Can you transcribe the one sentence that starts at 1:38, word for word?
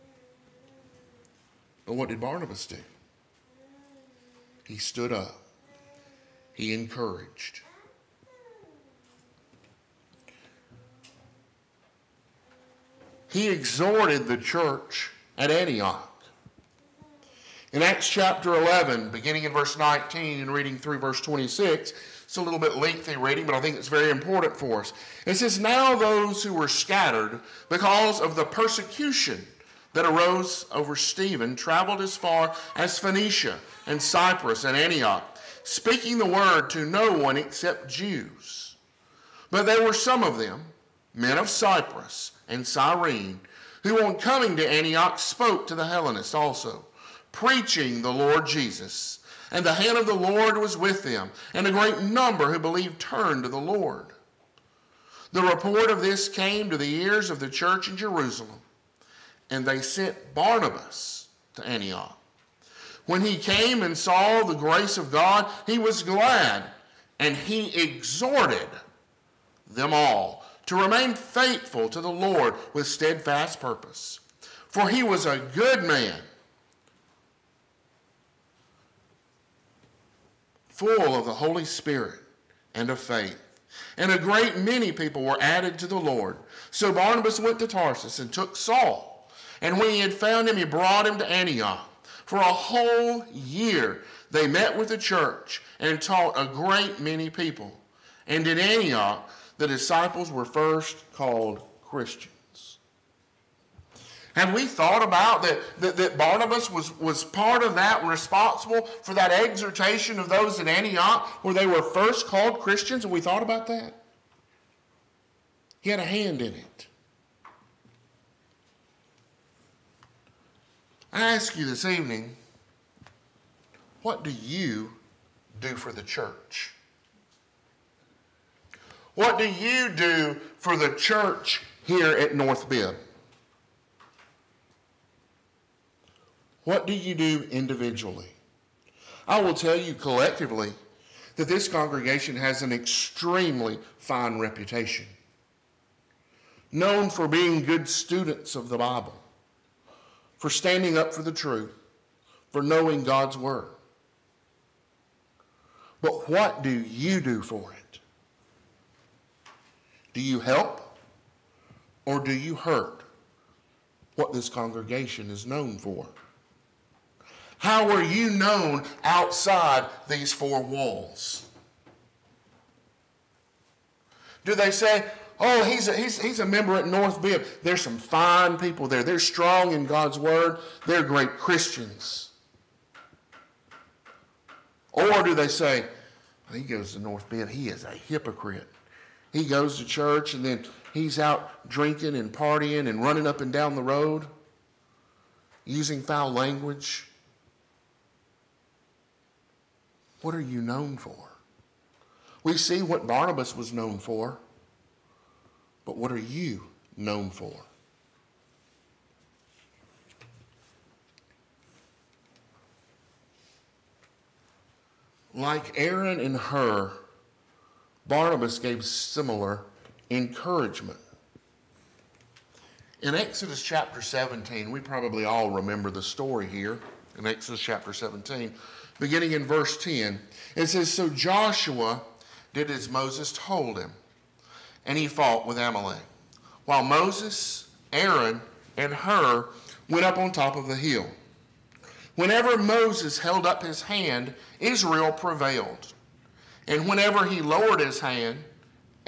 And in Antioch, the disciples were first called Christians.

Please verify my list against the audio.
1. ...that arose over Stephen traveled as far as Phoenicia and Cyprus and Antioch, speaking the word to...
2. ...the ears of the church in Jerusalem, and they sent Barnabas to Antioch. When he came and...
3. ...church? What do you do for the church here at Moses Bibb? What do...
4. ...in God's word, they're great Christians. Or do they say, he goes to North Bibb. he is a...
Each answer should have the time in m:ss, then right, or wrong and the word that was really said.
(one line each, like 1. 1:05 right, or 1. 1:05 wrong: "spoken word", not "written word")
1. 0:29 right
2. 0:56 right
3. 2:06 wrong: "North", not "Moses"
4. 2:59 right.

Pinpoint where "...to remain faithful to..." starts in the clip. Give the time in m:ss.
1:10.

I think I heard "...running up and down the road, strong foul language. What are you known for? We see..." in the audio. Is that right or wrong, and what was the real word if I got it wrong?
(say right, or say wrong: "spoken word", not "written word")
wrong: "using", not "strong".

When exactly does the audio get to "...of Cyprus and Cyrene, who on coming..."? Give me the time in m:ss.
0:41.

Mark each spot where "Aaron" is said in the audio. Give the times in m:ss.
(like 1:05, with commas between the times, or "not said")
3:35, 3:57.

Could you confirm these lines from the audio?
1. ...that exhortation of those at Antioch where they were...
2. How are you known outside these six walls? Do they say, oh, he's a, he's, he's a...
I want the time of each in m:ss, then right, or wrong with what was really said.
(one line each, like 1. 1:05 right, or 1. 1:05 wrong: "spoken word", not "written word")
1. 1:49 right
2. 2:47 wrong: "four", not "six".